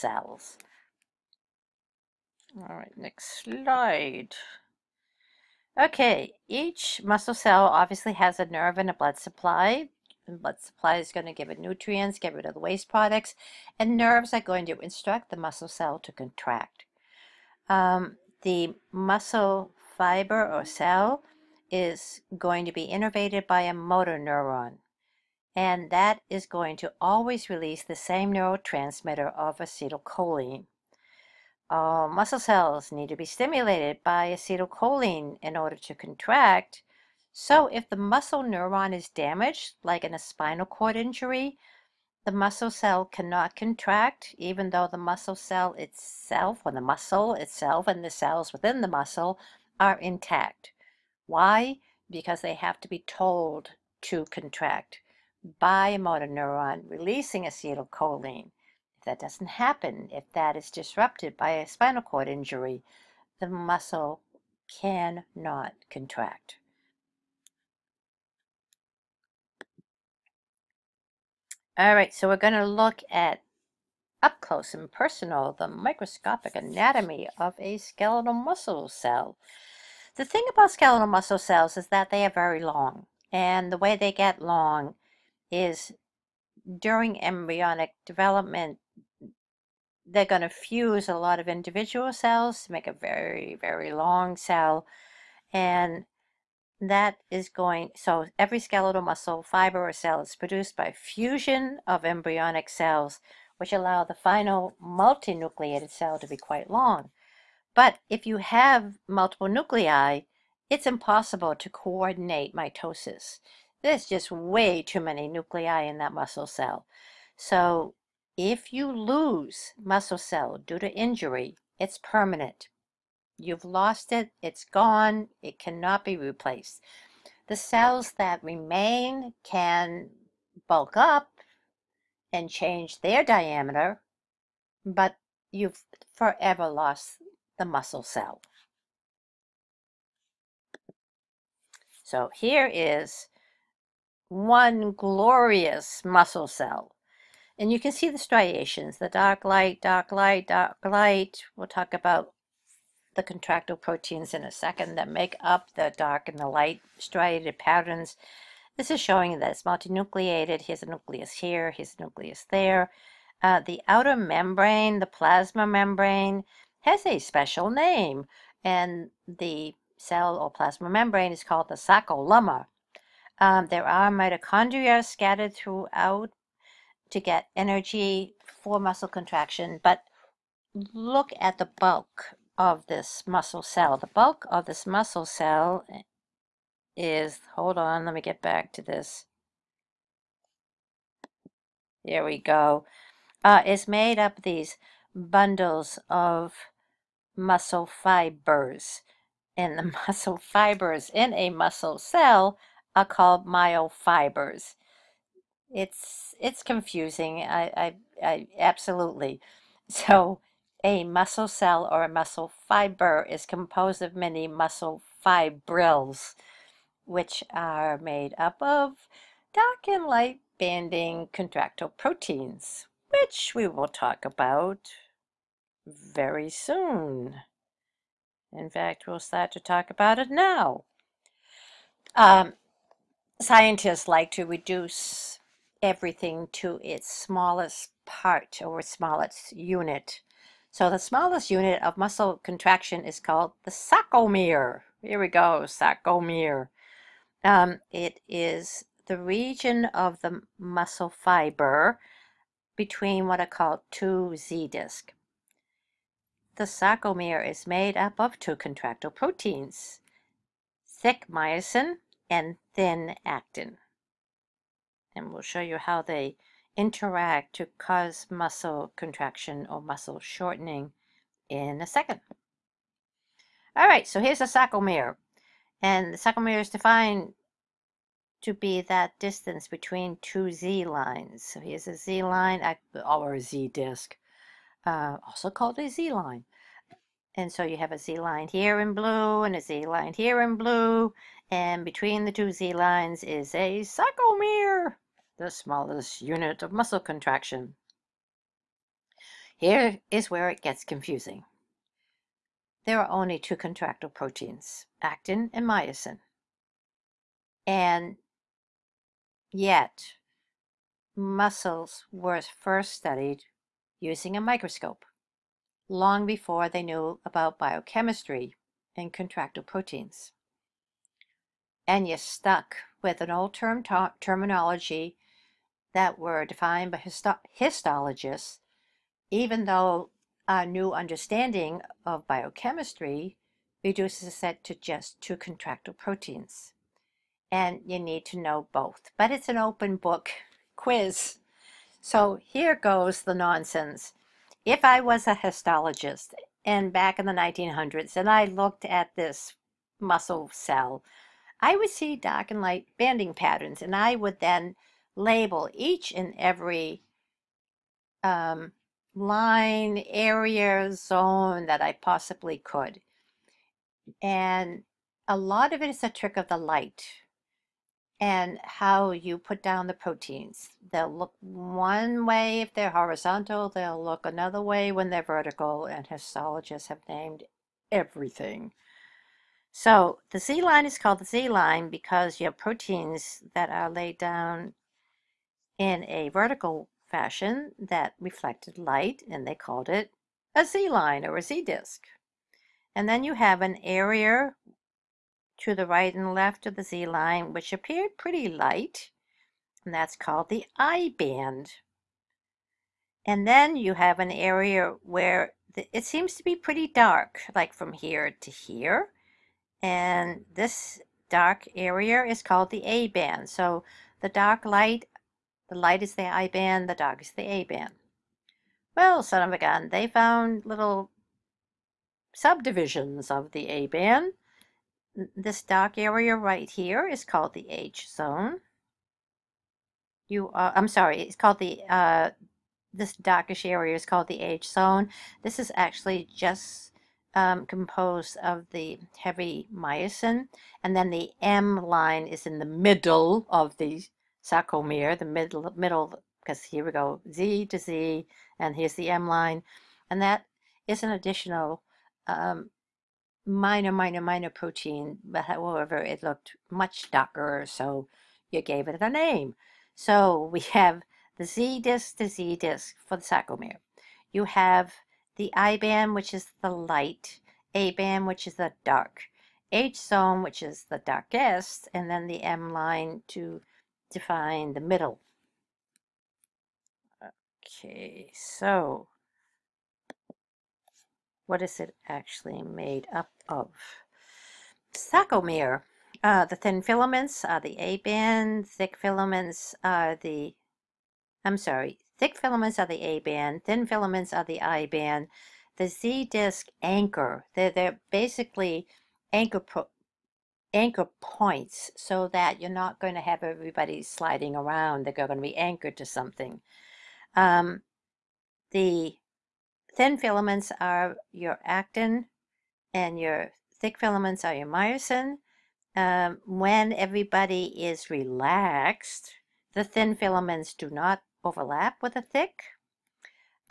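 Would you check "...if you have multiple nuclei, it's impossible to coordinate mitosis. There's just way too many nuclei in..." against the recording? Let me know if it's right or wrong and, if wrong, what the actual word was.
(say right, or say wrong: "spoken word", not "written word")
right.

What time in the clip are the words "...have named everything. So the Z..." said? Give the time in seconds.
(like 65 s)
376 s.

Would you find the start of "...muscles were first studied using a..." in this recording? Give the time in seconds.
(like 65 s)
311 s.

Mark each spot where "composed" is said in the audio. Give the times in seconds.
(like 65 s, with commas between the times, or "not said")
213 s, 437 s.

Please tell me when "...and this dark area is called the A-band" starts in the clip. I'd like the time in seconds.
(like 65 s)
409 s.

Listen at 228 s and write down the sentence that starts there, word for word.
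In fact, we'll start to talk about it now.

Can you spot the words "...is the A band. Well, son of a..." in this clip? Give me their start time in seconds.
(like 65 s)
417 s.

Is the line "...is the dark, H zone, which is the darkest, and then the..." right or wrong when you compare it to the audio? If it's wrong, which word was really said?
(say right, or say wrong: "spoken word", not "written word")
right.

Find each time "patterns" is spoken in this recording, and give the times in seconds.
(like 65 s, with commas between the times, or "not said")
157 s, 353 s.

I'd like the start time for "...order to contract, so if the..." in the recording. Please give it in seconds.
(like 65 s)
35 s.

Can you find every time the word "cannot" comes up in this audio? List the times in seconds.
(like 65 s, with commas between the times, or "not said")
43 s, 64 s, 125 s.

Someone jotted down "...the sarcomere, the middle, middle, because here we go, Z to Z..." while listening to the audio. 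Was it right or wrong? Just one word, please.
right.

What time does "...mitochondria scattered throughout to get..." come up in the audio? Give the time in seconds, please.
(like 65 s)
174 s.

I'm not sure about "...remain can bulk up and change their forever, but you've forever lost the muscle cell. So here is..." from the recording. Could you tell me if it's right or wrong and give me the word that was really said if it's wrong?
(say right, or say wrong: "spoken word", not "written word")
wrong: "diameter", not "forever".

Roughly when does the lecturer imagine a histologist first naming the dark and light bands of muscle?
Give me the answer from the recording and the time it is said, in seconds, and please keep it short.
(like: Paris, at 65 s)
the 1900s, at 347 s.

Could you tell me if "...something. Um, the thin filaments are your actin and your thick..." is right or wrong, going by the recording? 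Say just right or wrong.
right.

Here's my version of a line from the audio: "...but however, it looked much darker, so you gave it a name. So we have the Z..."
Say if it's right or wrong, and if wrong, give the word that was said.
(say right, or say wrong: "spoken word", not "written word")
right.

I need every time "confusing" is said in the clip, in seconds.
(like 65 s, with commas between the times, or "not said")
206 s, 300 s.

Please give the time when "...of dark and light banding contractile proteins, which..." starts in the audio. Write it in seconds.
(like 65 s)
218 s.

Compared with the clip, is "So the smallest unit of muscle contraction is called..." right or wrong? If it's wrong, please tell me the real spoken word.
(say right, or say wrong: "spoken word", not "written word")
right.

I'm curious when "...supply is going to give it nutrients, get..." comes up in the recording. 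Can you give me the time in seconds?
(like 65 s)
10 s.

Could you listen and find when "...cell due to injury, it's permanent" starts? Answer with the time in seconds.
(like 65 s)
120 s.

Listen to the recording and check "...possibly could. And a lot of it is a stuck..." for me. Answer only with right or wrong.
wrong.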